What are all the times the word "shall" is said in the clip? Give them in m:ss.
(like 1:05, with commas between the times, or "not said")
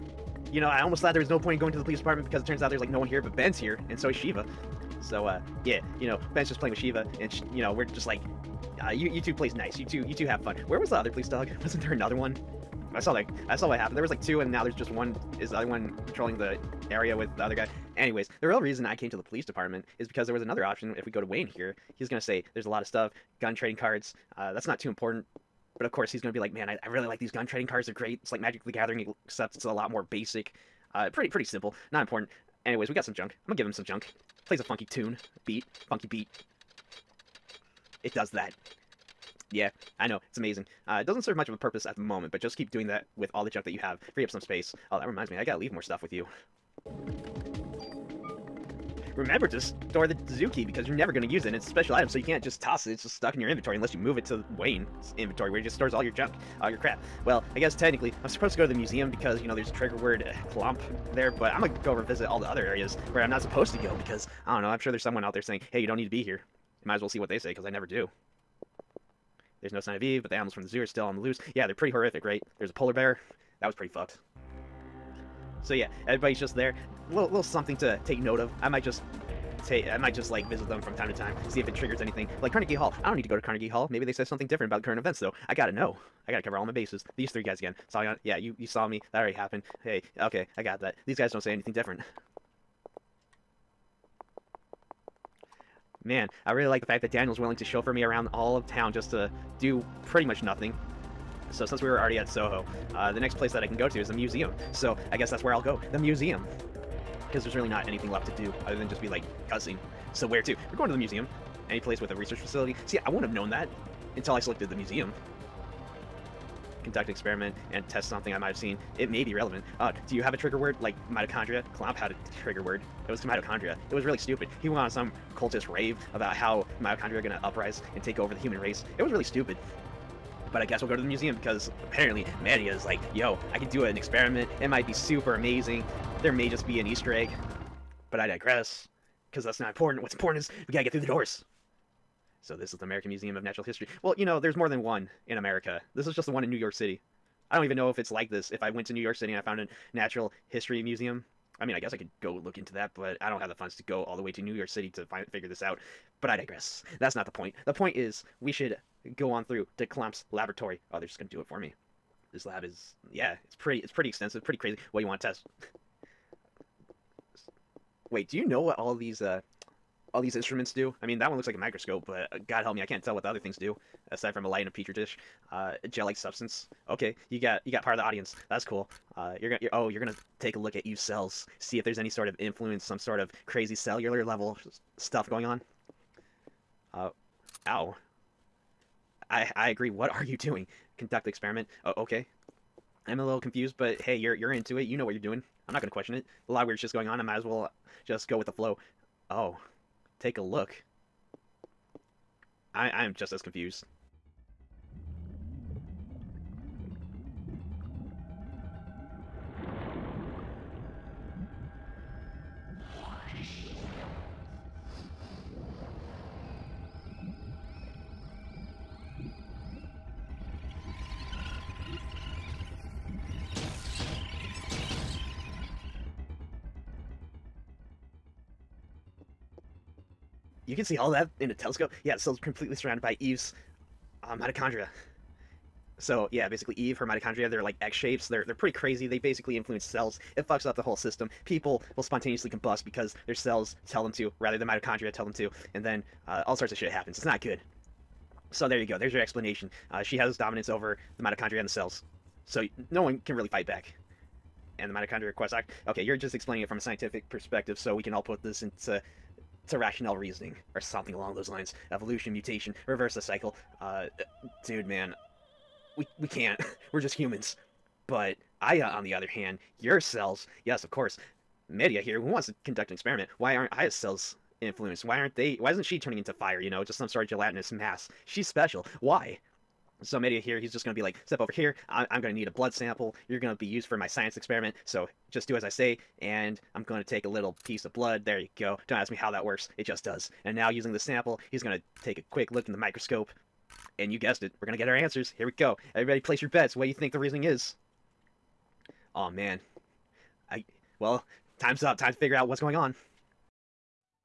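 not said.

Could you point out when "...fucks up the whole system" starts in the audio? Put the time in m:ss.
4:00.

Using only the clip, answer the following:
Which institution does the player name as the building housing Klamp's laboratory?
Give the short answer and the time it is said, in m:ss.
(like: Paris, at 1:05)
American Museum of Natural History, at 2:22.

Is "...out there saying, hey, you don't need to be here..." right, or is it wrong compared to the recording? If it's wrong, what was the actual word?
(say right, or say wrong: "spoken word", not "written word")
right.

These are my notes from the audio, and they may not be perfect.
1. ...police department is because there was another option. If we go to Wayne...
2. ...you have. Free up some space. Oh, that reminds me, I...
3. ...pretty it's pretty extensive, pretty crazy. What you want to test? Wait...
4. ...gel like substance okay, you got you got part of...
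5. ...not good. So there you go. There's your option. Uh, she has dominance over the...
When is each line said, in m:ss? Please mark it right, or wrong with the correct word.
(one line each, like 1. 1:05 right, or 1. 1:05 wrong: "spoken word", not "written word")
1. 0:19 right
2. 0:43 right
3. 2:43 right
4. 2:55 right
5. 4:07 wrong: "explanation", not "option".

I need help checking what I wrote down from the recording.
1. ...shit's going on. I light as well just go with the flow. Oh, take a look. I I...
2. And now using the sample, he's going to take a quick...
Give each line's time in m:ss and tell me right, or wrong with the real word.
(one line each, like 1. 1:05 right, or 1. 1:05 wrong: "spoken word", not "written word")
1. 3:16 wrong: "might", not "light"
2. 4:50 right.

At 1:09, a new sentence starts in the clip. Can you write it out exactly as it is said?
There's no sign of Eve, but the animals from the zoo are still on the loose.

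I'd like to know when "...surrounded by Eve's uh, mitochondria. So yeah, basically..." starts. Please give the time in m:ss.
3:52.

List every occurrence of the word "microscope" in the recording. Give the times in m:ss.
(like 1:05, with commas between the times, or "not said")
2:51, 4:52.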